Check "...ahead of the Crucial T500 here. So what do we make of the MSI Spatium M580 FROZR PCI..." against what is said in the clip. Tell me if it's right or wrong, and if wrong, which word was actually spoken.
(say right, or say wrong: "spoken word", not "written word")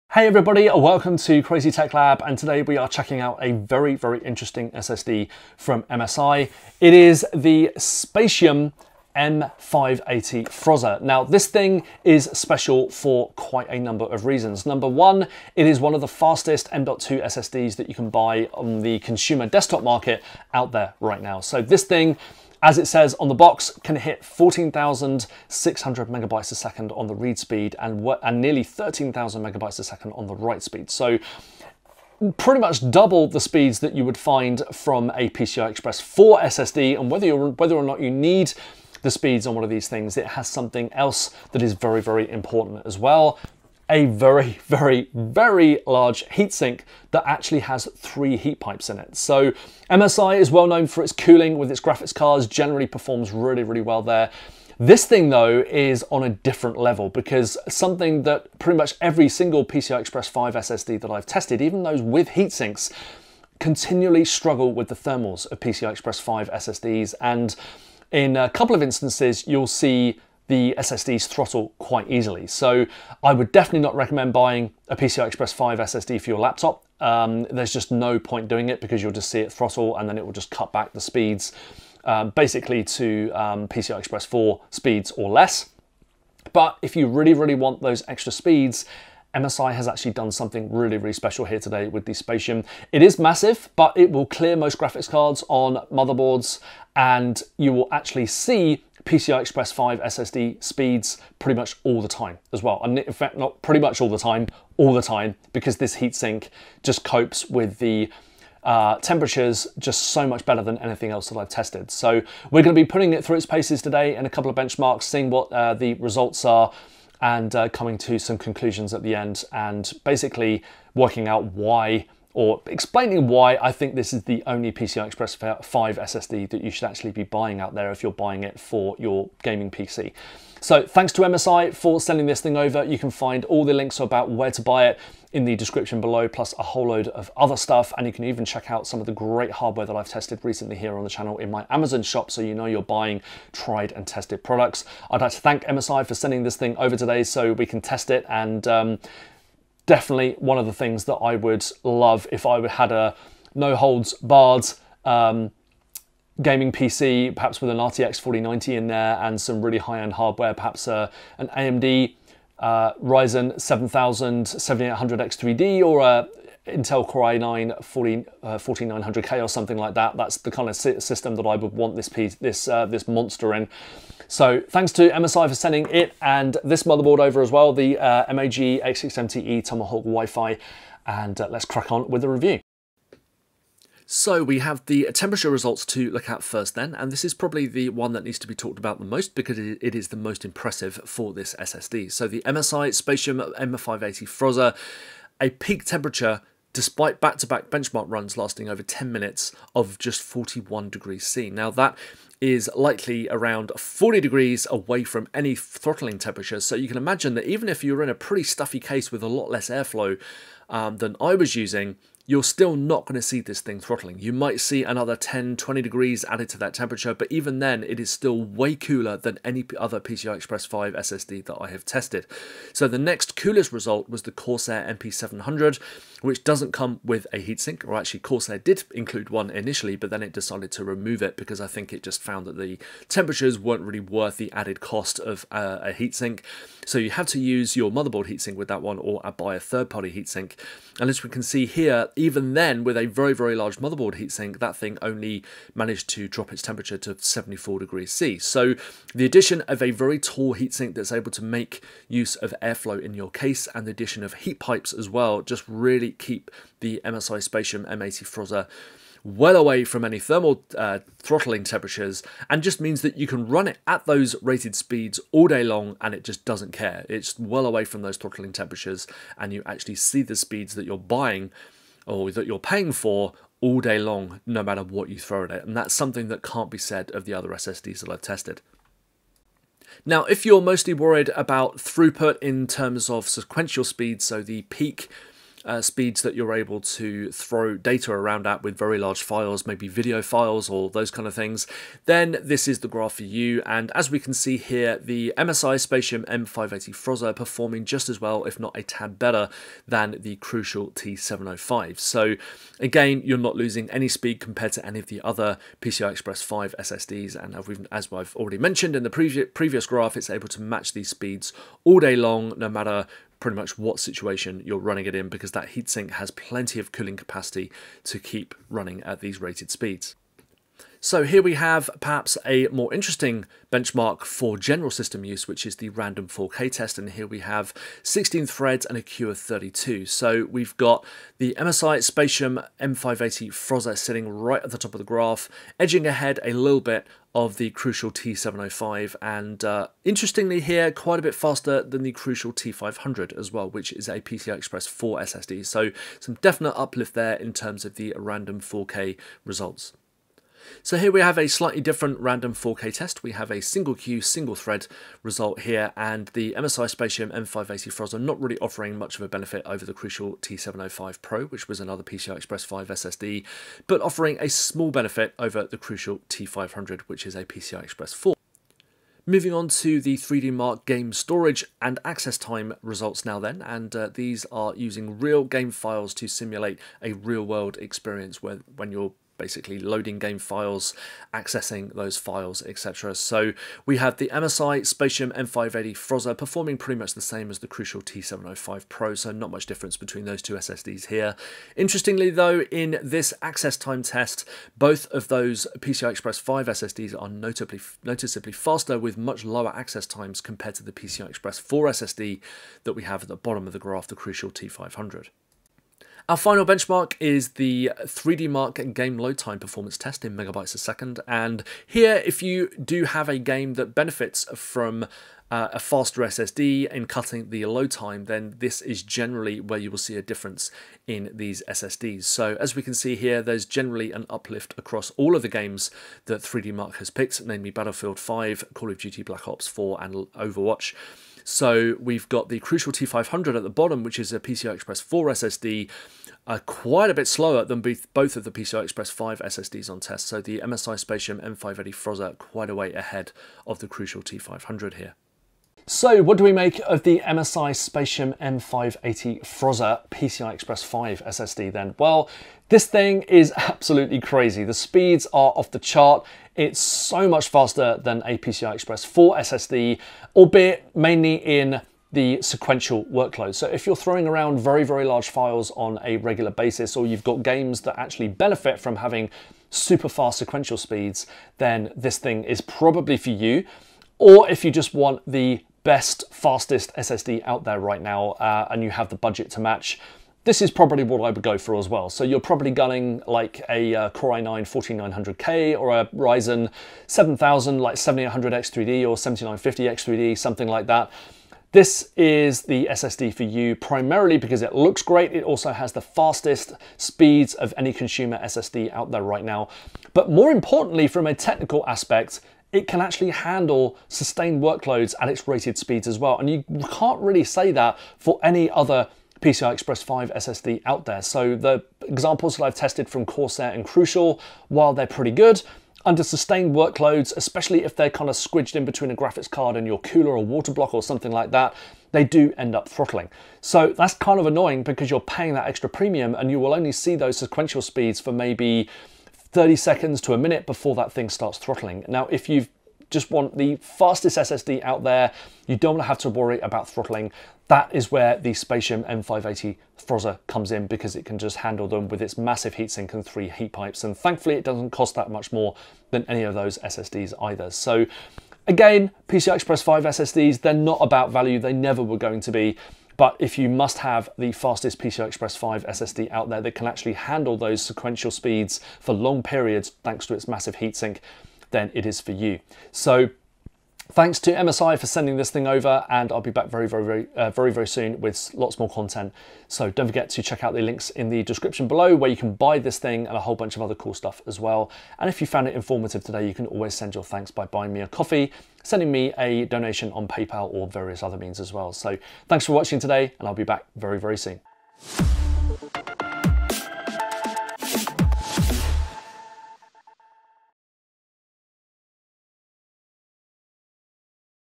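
right.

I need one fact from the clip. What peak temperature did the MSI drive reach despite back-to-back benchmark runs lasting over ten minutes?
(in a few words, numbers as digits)
41 degrees C.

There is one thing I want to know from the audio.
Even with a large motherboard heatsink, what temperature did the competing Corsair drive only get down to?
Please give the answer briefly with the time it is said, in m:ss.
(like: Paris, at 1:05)
74 degrees C, at 4:07.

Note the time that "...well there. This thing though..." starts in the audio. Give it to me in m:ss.
0:53.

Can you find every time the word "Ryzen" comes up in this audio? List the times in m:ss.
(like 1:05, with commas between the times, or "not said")
2:43, 8:06.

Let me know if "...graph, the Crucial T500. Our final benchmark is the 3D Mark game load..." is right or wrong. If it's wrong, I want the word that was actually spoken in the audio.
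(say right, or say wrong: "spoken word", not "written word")
right.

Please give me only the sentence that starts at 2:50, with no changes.
That's the kind of system that I would want this piece, this uh, this monster in.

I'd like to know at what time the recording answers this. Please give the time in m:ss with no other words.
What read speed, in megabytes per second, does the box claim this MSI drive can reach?
0:24.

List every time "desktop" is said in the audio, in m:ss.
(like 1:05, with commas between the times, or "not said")
0:19.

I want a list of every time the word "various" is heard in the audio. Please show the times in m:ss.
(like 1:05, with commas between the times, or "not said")
9:40.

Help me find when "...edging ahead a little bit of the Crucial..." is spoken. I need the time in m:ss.
5:35.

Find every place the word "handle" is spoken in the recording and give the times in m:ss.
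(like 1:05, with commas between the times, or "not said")
8:23, 9:01, 9:17.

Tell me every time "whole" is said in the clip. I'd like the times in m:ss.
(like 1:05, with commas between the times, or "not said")
2:16, 9:33.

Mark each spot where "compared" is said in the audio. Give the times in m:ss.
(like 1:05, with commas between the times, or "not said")
5:04, 6:40.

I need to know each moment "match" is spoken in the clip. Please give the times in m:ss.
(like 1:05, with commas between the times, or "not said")
5:10, 7:59.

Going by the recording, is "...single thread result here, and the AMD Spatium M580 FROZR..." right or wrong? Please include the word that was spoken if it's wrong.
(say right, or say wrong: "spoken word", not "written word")
wrong: "MSI", not "AMD".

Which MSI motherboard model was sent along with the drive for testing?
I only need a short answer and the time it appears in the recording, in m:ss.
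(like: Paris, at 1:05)
MAG X670E Tomahawk Wi-Fi, at 2:58.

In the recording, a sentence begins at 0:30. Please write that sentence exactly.
So pretty much double the speeds that you would find from a PCI Express 4 SSD.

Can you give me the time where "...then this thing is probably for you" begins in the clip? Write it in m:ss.
7:51.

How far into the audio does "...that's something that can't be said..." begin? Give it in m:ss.
4:35.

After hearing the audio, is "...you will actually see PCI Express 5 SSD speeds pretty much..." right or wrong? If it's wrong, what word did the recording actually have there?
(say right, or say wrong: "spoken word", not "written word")
right.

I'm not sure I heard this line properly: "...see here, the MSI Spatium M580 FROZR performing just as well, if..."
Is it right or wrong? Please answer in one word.
right.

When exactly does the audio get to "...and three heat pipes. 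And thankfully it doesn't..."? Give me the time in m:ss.
9:03.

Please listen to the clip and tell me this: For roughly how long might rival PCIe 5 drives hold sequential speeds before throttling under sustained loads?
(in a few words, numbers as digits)
30 seconds to a minute.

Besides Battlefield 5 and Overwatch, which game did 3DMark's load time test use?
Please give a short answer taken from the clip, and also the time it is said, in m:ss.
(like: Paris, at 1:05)
Call of Duty Black Ops 4, at 7:08.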